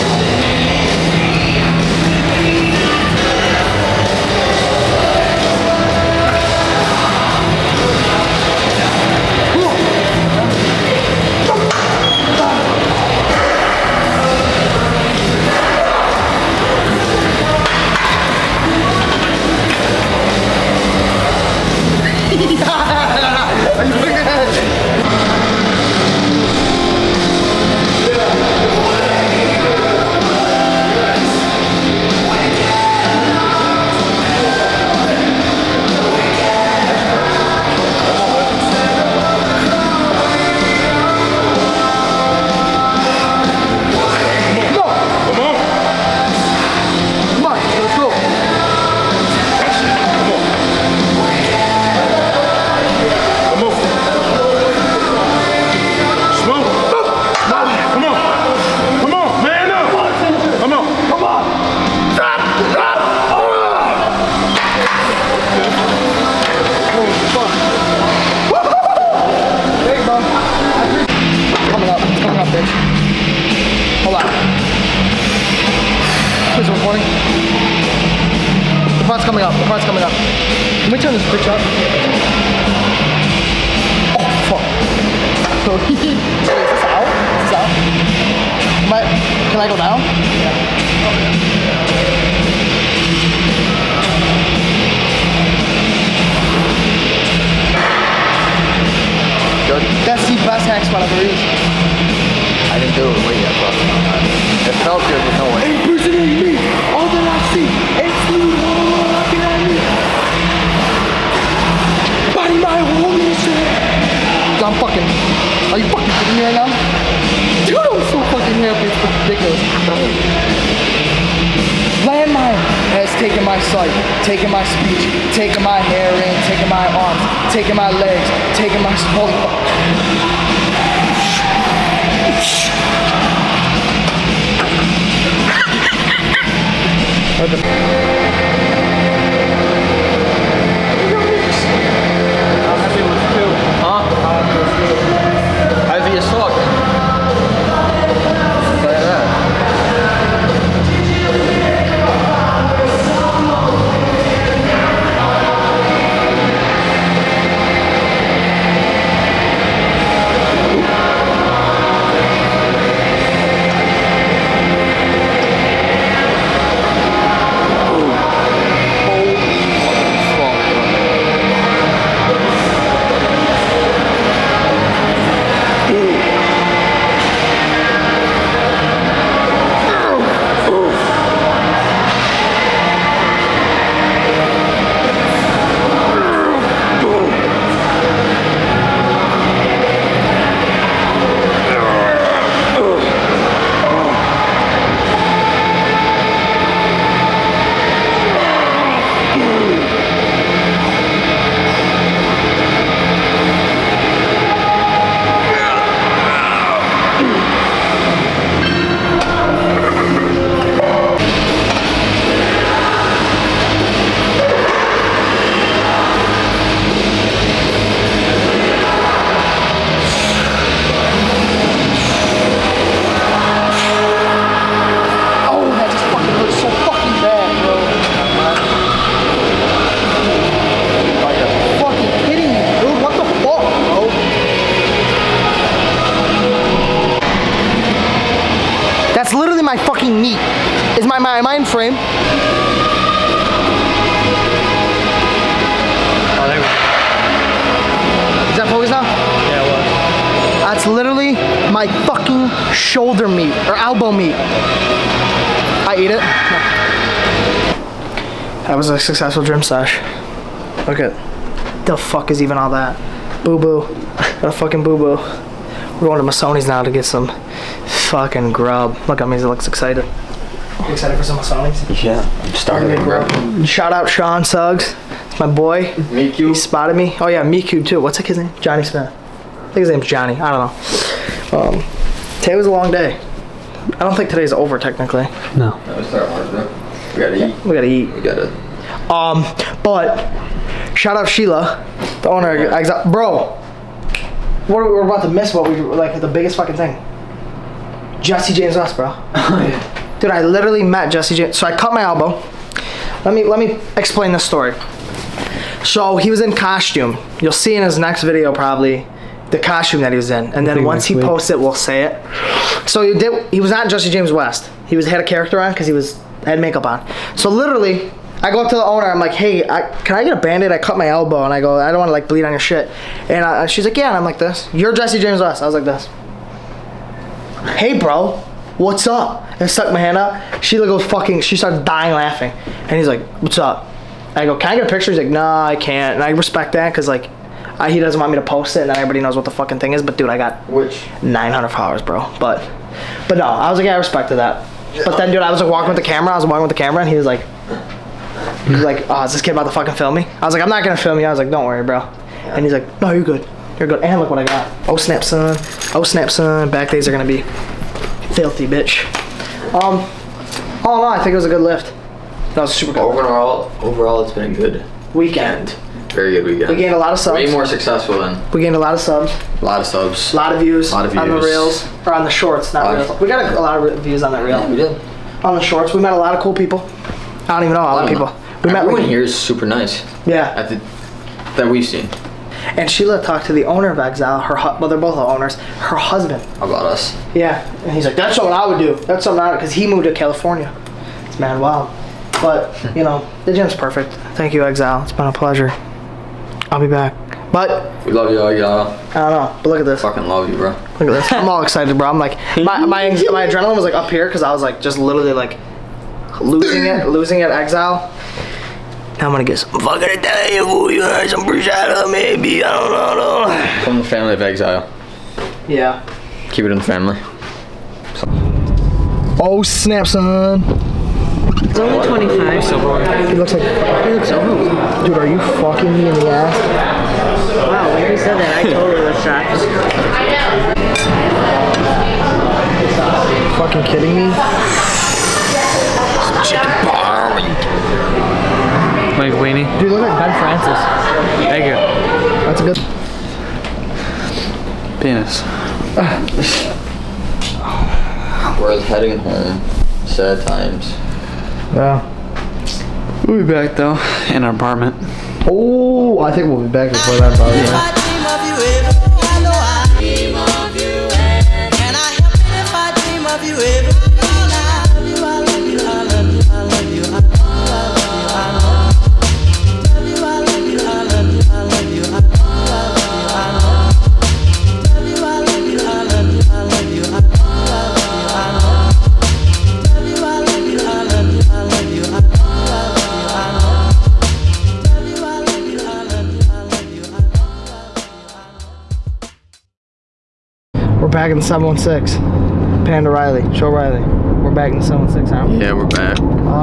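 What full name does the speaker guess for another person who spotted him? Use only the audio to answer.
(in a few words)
Johnny Smith.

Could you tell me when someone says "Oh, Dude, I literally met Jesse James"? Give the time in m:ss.
4:59.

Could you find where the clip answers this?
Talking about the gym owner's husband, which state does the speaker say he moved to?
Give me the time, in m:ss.
6:30.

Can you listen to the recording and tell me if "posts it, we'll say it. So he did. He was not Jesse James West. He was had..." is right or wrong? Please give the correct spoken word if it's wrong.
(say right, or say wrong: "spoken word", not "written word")
right.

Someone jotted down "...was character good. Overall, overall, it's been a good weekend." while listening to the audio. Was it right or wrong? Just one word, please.
wrong.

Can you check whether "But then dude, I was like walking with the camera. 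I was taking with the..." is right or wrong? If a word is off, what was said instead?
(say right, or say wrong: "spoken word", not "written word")
wrong: "walking", not "taking".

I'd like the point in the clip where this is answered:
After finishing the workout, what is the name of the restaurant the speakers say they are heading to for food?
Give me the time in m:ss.
4:26.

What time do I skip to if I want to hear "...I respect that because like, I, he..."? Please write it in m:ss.
5:36.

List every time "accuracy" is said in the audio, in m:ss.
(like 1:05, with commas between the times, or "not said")
not said.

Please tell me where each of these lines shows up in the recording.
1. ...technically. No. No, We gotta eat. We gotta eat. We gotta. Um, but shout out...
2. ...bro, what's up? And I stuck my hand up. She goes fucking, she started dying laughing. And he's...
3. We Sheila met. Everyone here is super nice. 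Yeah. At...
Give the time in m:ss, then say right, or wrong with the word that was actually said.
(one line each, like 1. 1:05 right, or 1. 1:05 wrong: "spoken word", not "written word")
1. 4:44 right
2. 5:27 right
3. 6:18 wrong: "Everyone", not "Sheila".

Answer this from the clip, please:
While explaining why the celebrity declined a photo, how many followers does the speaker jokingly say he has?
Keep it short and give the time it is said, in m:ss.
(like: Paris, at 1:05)
900, at 5:41.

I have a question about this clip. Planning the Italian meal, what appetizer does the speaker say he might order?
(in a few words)
Bruschetta.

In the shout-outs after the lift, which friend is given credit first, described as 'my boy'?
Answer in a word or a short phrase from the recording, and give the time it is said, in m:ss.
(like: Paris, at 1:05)
Sean Suggs, at 4:34.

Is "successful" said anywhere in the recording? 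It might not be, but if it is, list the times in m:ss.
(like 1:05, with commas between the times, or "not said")
4:18, 6:07.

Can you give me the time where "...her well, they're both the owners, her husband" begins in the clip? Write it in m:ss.
6:24.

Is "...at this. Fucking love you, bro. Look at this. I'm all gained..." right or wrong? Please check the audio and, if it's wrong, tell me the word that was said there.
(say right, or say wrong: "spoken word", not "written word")
wrong: "excited", not "gained".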